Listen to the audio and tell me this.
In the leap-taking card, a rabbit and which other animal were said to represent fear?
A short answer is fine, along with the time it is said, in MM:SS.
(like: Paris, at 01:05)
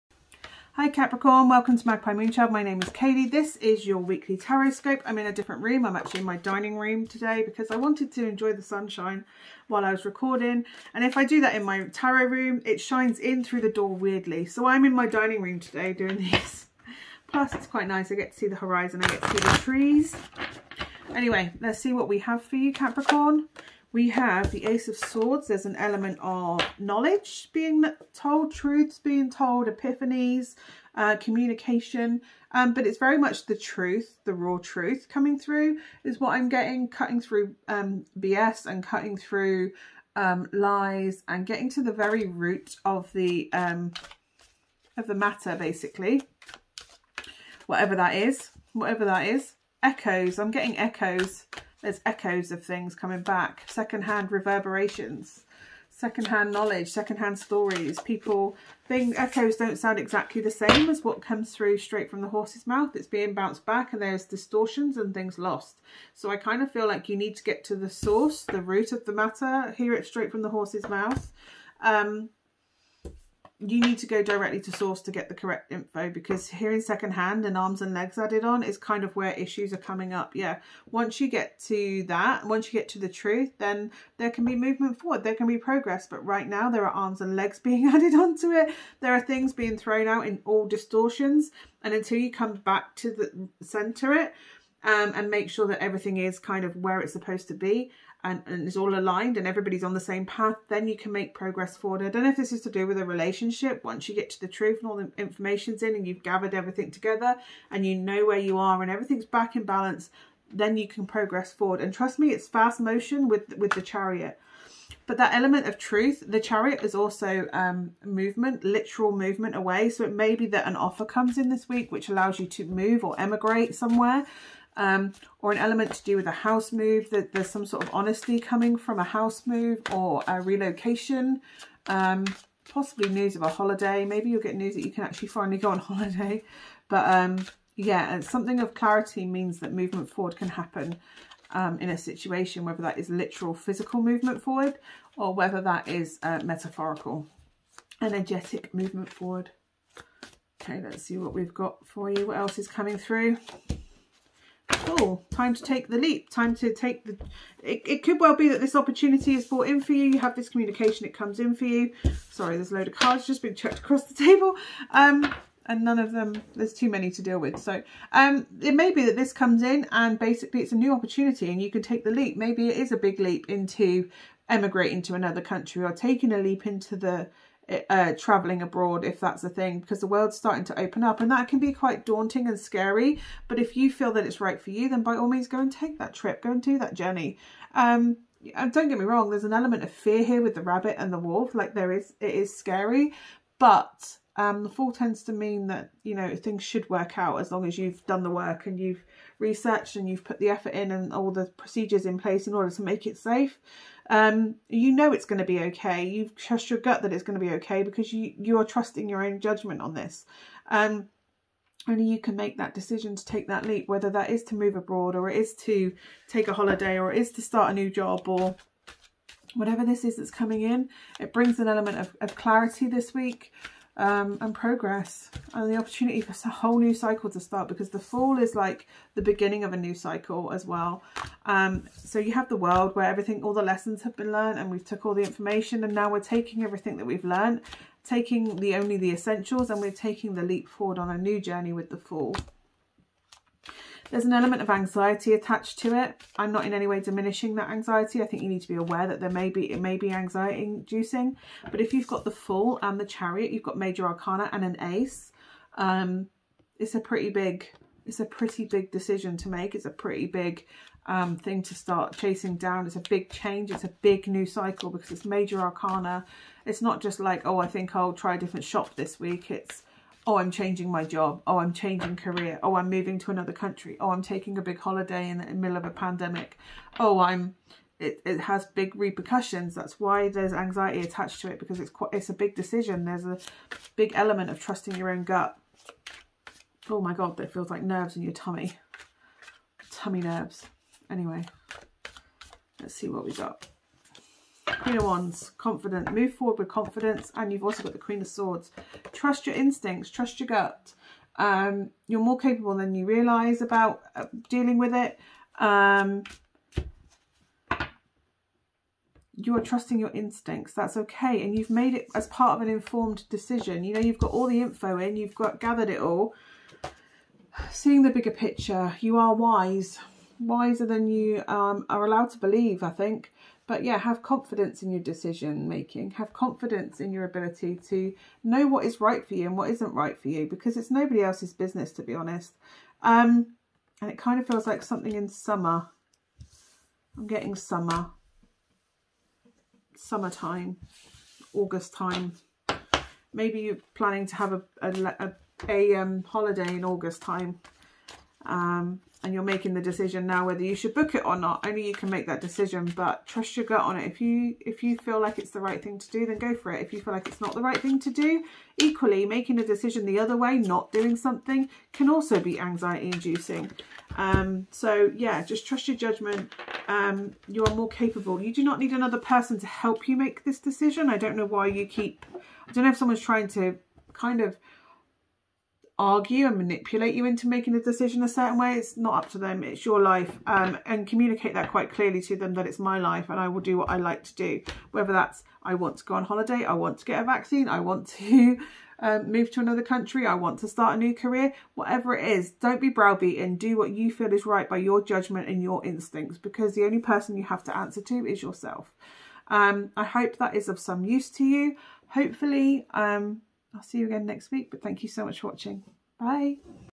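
Wolf, at 03:11.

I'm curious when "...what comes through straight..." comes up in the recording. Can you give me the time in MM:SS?
01:01.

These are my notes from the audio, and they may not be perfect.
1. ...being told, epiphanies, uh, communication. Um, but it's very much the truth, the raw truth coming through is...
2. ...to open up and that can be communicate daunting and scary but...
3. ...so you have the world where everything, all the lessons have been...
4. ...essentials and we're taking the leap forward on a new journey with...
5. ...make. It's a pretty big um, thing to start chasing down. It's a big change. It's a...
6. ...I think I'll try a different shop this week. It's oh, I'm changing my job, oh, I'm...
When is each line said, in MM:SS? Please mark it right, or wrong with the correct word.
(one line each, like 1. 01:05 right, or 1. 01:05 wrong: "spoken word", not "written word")
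1. 00:28 right
2. 03:00 wrong: "quite", not "communicate"
3. 03:51 right
4. 03:59 right
5. 04:19 right
6. 04:27 right.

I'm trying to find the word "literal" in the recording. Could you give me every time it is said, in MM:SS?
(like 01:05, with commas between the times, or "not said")
01:58, 02:23.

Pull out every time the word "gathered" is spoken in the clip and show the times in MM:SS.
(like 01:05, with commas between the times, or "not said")
01:46, 05:15.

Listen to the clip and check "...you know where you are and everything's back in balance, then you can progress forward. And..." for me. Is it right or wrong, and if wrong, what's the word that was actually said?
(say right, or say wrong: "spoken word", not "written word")
right.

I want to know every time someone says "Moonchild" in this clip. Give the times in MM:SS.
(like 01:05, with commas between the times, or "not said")
00:02.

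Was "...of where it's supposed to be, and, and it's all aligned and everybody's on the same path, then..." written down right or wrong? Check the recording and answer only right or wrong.
right.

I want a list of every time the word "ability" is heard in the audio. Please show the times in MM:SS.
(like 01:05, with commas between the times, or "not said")
05:27.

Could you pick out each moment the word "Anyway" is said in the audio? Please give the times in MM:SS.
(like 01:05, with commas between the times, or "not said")
00:21, 04:51.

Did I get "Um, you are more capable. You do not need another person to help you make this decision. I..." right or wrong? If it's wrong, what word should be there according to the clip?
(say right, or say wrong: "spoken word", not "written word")
right.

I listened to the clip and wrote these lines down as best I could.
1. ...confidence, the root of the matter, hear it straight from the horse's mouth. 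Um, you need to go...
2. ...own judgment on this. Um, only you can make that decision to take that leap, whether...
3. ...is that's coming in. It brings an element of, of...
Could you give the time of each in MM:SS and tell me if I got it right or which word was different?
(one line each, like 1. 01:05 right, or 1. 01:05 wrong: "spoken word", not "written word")
1. 01:07 wrong: "source", not "confidence"
2. 03:29 right
3. 03:40 right.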